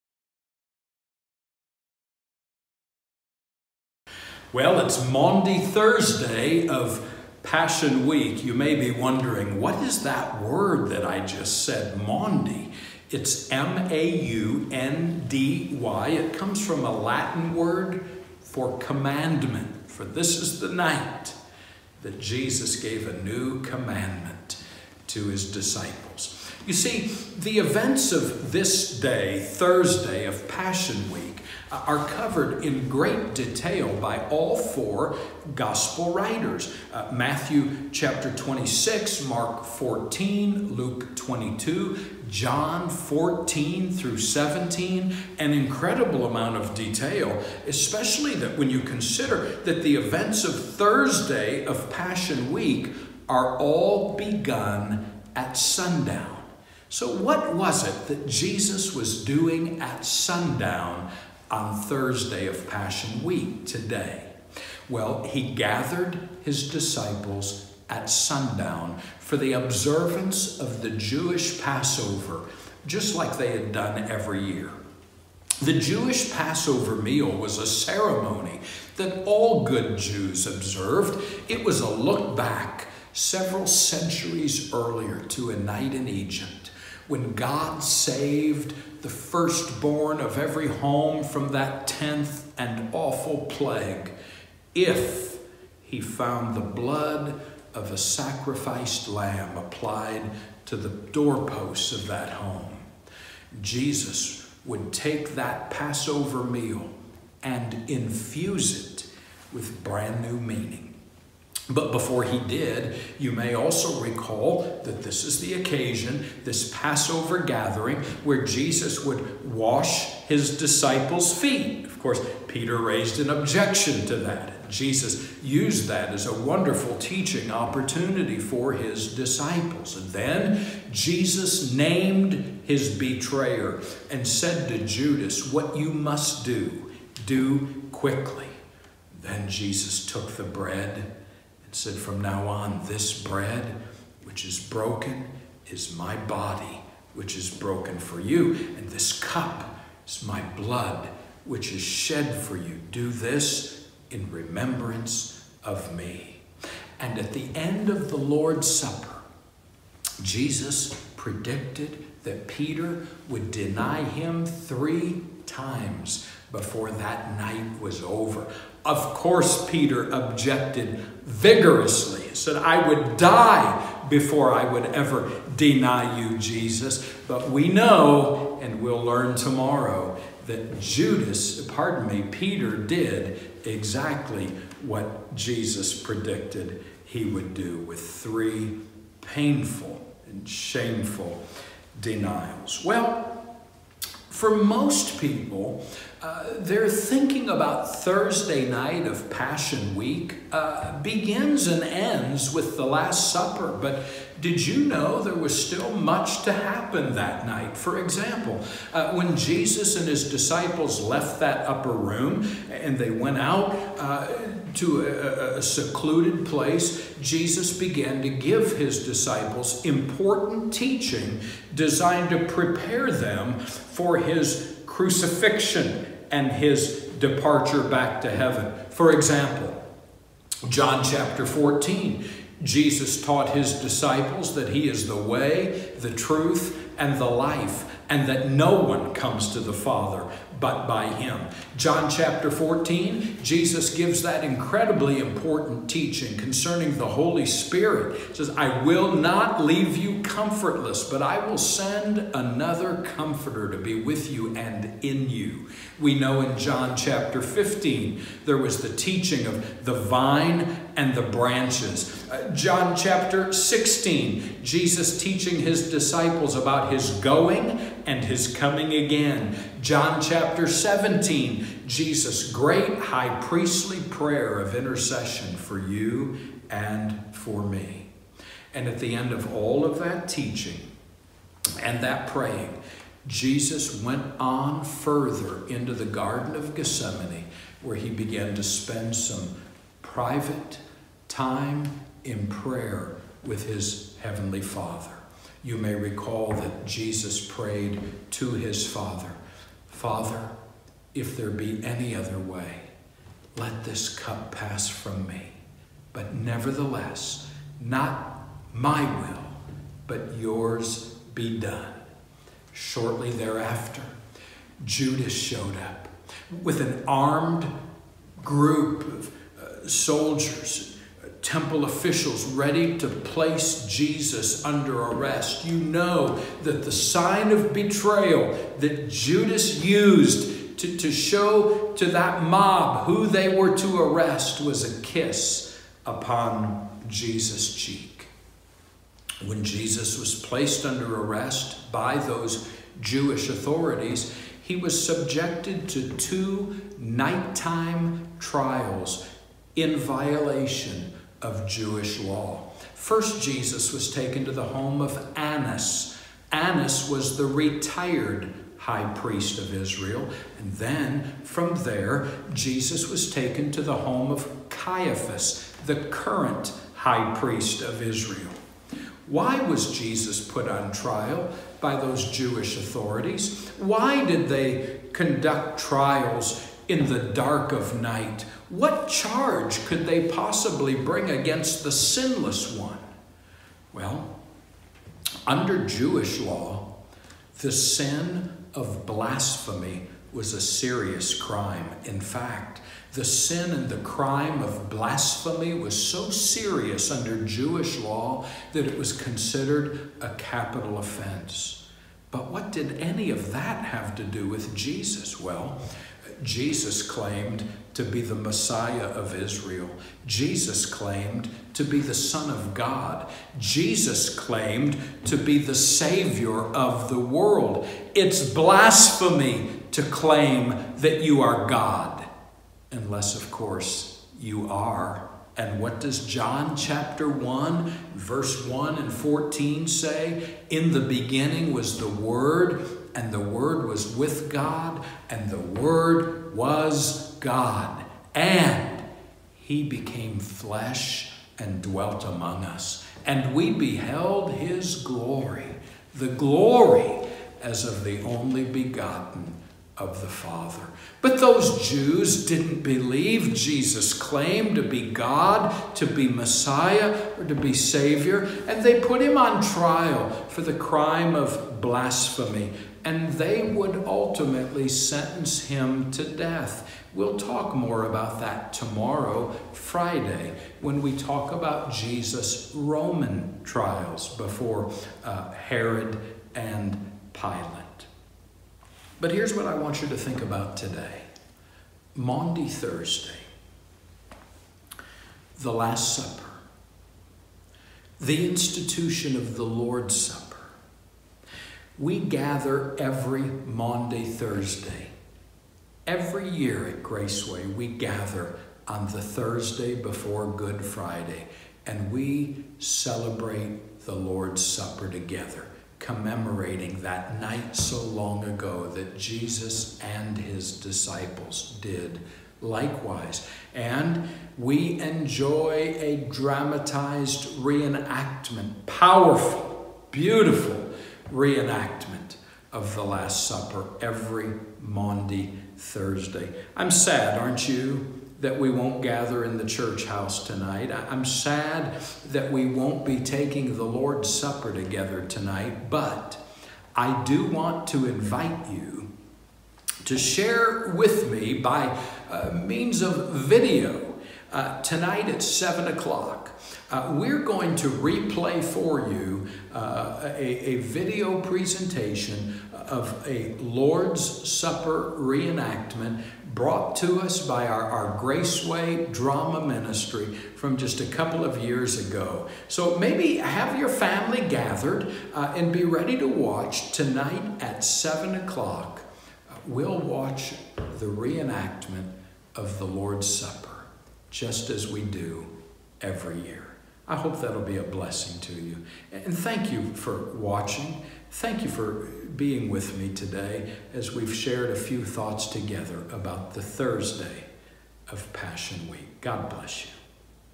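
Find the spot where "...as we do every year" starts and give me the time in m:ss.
9:34.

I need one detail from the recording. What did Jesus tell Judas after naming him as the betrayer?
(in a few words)
What you must do, do quickly.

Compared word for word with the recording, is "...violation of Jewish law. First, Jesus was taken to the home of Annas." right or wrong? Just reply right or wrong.
right.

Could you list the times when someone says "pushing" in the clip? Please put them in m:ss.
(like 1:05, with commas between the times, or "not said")
not said.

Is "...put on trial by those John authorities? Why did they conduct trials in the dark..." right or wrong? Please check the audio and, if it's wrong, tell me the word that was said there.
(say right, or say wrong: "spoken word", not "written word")
wrong: "Jewish", not "John".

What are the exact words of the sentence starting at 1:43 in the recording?
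Jesus would take that Passover meal and infuse it with brand new meaning.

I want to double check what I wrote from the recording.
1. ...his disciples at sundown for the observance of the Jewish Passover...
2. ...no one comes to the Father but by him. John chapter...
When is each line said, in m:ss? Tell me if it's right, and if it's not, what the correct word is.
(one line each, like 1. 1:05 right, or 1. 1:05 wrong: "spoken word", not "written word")
1. 1:06 right
2. 3:58 right.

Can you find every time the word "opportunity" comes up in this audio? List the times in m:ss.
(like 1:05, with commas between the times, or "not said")
2:07.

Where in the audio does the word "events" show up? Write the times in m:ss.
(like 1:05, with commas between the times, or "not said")
0:27, 0:49.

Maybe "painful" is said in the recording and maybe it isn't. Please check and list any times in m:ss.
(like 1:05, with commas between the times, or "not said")
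3:09.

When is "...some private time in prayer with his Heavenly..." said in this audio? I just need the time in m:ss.
4:49.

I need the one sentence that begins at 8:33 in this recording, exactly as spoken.
And we enjoy a dramatized reenactment, powerful, beautiful reenactment of the Last Supper every Maundy Thursday.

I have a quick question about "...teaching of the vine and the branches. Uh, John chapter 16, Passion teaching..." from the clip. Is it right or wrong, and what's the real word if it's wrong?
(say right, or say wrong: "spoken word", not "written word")
wrong: "Jesus", not "Passion".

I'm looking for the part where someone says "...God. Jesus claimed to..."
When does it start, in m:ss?
6:52.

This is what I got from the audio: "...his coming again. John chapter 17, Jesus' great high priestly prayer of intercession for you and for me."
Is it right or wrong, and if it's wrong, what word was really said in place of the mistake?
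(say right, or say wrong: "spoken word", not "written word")
right.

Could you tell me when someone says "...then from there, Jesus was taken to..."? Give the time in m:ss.
6:00.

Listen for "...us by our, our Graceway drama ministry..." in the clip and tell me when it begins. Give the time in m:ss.
9:17.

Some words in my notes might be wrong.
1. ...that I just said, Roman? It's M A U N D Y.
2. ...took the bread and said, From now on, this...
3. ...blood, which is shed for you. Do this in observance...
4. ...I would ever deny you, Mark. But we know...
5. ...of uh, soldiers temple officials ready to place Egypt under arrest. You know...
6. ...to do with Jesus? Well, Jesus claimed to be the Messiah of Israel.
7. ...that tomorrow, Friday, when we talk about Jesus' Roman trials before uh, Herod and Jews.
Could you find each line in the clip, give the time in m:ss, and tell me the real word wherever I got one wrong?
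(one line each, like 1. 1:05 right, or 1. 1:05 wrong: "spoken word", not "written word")
1. 0:10 wrong: "Maundy", not "Roman"
2. 2:20 right
3. 2:30 wrong: "remembrance", not "observance"
4. 2:54 wrong: "Jesus", not "Mark"
5. 5:19 wrong: "Jesus", not "Egypt"
6. 6:44 right
7. 7:48 wrong: "Pilate", not "Jews".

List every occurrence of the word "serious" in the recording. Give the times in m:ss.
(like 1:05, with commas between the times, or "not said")
6:30, 6:36.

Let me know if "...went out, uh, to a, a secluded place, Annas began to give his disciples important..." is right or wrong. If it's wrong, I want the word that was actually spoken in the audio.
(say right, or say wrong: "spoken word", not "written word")
wrong: "Jesus", not "Annas".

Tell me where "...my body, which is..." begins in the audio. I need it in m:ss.
2:25.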